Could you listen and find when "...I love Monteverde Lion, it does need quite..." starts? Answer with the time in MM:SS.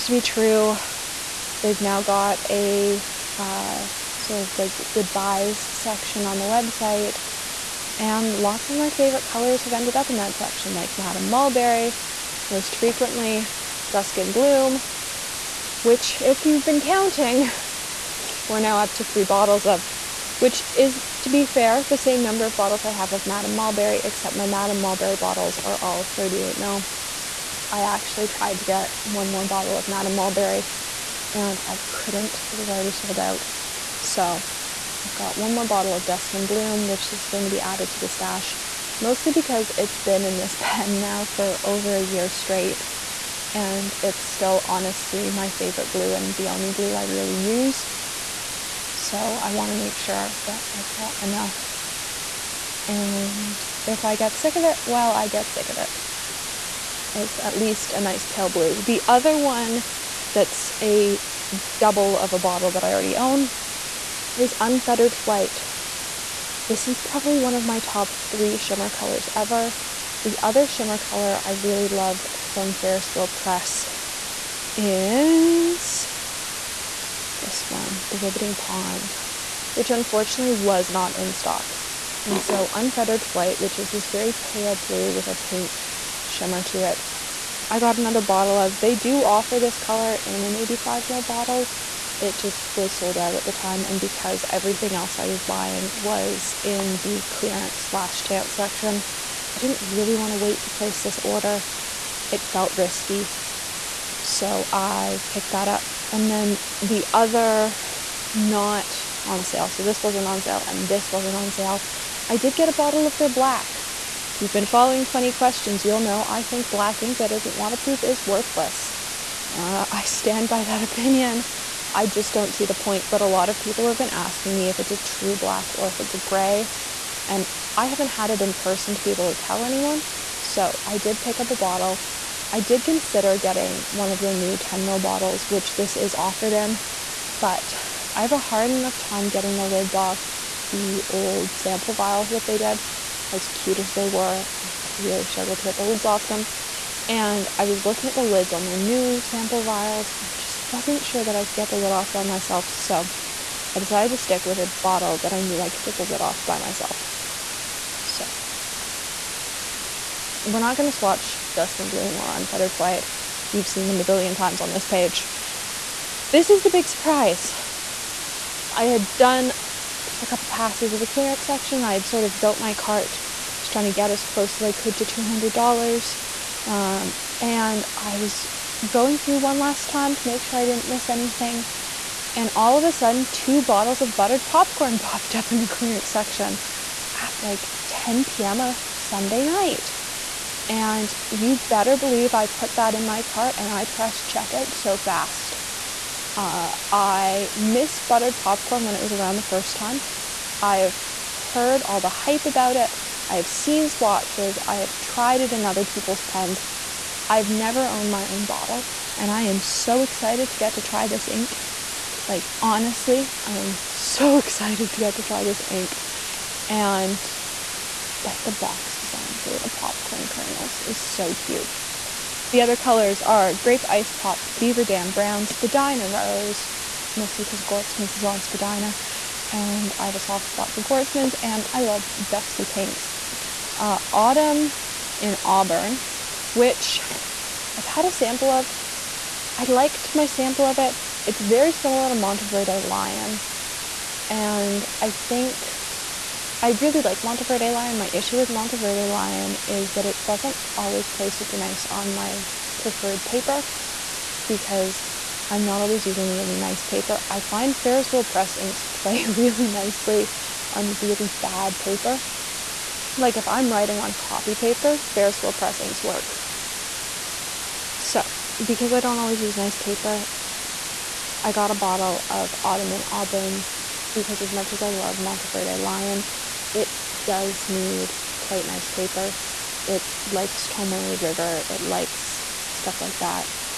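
04:34.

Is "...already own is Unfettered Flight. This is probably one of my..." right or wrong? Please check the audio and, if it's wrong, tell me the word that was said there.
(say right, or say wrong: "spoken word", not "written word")
right.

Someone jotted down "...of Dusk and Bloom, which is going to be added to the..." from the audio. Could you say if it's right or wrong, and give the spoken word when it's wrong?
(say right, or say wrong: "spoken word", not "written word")
right.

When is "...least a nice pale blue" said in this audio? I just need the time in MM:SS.
00:57.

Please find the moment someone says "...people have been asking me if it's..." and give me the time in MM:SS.
02:03.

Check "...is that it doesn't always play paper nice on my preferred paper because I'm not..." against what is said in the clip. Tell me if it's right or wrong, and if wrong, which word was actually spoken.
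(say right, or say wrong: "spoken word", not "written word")
wrong: "super", not "paper".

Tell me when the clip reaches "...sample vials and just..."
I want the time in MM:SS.
02:29.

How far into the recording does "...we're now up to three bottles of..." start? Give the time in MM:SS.
00:18.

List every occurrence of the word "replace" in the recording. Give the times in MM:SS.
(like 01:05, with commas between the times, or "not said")
not said.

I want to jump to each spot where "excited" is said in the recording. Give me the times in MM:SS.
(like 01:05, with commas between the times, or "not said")
03:30, 03:34.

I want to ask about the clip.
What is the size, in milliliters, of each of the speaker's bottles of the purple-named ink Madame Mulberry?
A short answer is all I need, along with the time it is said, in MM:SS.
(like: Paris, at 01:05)
38 ml, at 00:26.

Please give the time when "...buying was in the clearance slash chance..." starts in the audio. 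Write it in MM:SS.
01:35.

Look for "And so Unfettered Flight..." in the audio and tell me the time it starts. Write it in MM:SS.
01:22.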